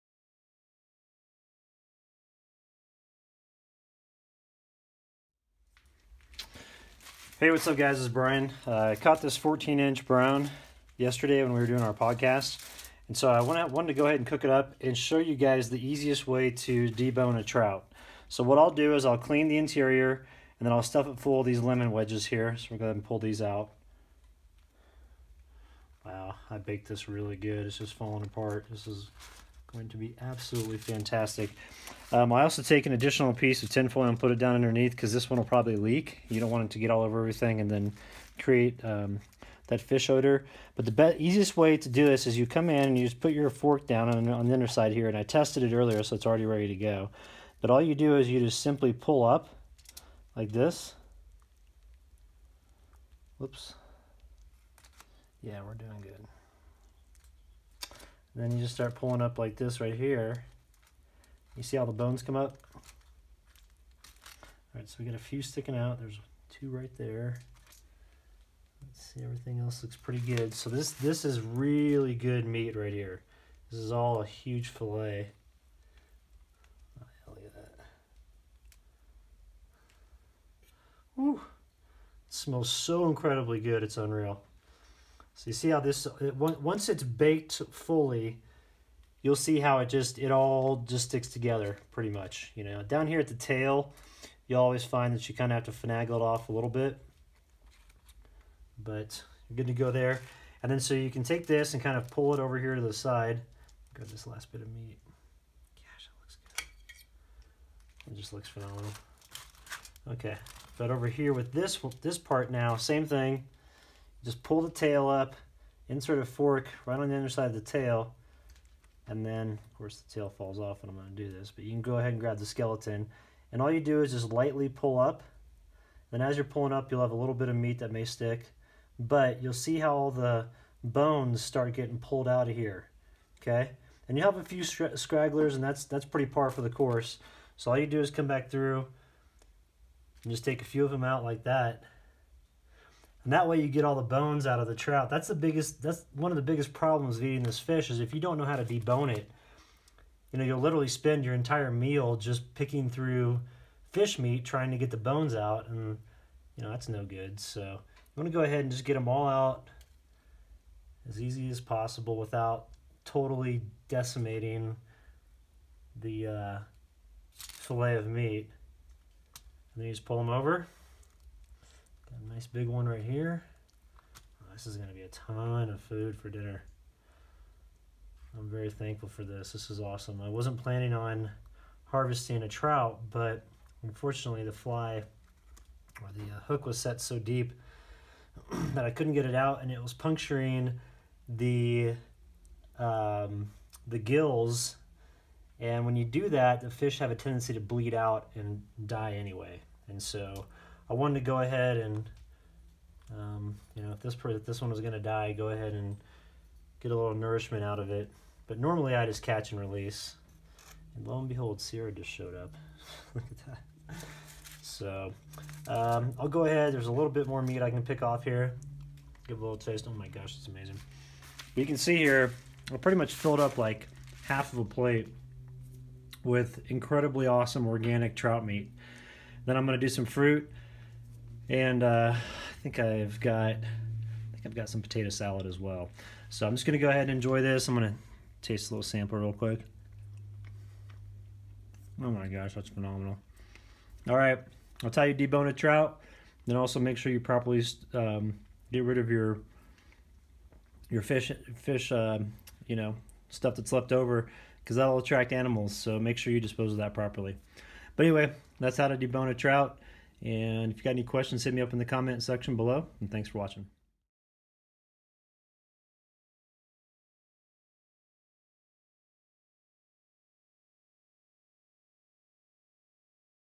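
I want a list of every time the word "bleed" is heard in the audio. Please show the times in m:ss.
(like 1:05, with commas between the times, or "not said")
3:17.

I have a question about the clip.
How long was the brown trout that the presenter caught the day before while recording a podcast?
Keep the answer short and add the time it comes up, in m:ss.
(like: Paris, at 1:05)
14 inches, at 0:09.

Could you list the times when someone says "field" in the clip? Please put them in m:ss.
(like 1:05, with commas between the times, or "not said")
not said.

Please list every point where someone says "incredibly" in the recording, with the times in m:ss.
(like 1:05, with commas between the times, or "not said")
1:23, 3:46.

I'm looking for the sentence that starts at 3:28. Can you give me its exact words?
But normally I just catch and release.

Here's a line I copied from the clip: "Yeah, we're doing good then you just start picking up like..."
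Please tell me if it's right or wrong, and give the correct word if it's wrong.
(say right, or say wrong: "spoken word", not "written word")
wrong: "pulling", not "picking".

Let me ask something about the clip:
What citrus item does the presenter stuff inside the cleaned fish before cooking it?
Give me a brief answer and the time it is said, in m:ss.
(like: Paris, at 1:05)
lemon wedges, at 0:21.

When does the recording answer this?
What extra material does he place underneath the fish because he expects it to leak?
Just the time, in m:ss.
0:33.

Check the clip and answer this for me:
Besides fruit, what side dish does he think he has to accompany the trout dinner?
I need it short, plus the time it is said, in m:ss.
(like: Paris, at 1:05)
potato salad, at 3:54.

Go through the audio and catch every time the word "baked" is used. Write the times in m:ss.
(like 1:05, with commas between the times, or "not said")
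0:26, 1:27.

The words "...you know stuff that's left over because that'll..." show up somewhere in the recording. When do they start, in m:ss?
4:12.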